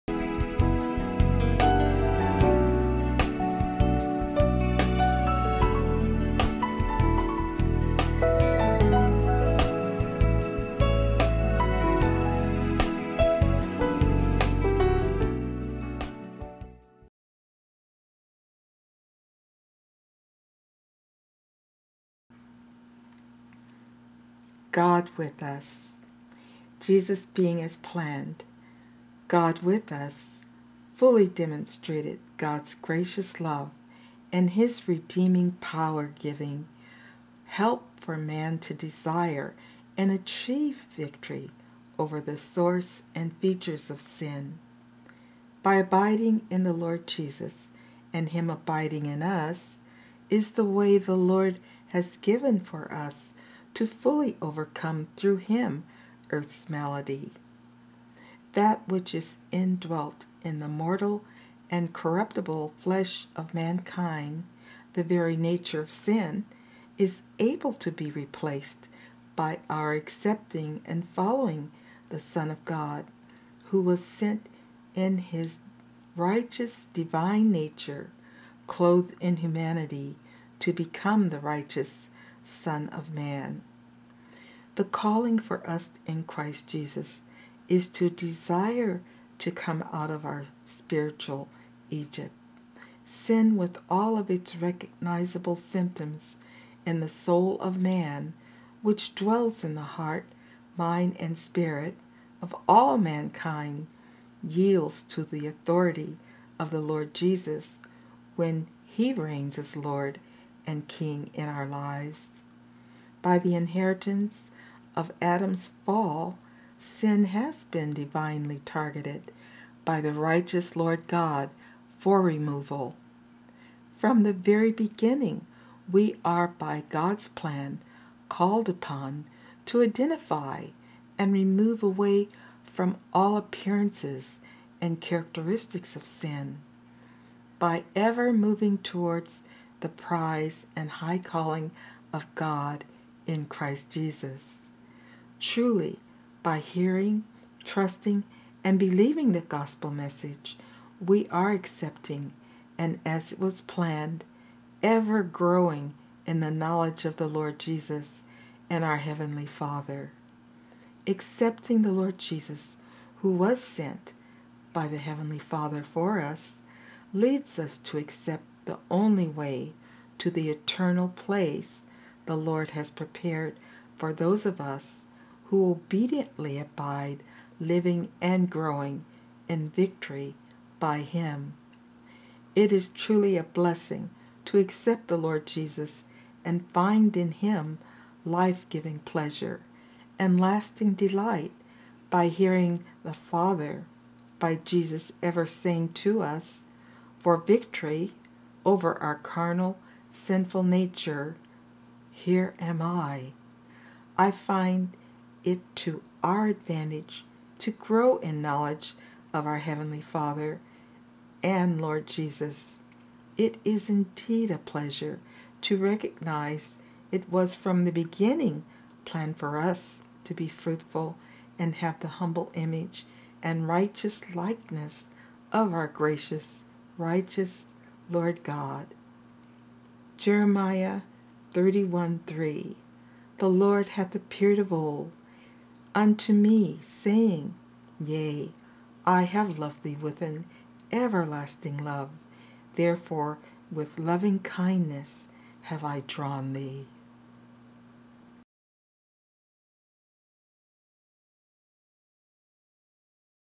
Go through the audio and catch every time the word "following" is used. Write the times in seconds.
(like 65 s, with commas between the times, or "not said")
71 s.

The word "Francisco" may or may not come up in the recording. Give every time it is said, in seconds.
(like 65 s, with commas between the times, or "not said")
not said.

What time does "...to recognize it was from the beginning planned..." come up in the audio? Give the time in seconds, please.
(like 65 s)
215 s.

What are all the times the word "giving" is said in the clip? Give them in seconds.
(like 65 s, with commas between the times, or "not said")
36 s, 188 s.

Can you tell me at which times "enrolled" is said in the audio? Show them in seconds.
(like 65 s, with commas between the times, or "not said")
not said.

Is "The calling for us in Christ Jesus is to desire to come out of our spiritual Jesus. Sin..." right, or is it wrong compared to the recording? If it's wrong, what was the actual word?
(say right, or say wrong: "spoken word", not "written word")
wrong: "Egypt", not "Jesus".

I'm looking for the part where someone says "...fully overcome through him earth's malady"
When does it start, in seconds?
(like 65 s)
53 s.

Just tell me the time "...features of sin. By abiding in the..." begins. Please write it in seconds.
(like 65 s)
43 s.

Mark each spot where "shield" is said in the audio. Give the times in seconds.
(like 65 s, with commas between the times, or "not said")
not said.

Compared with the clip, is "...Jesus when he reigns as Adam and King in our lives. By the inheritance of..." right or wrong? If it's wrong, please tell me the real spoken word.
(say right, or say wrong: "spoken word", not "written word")
wrong: "Lord", not "Adam".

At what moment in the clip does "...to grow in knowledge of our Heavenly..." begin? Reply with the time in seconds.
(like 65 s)
207 s.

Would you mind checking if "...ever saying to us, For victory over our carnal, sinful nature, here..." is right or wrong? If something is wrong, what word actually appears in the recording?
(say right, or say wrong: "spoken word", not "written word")
right.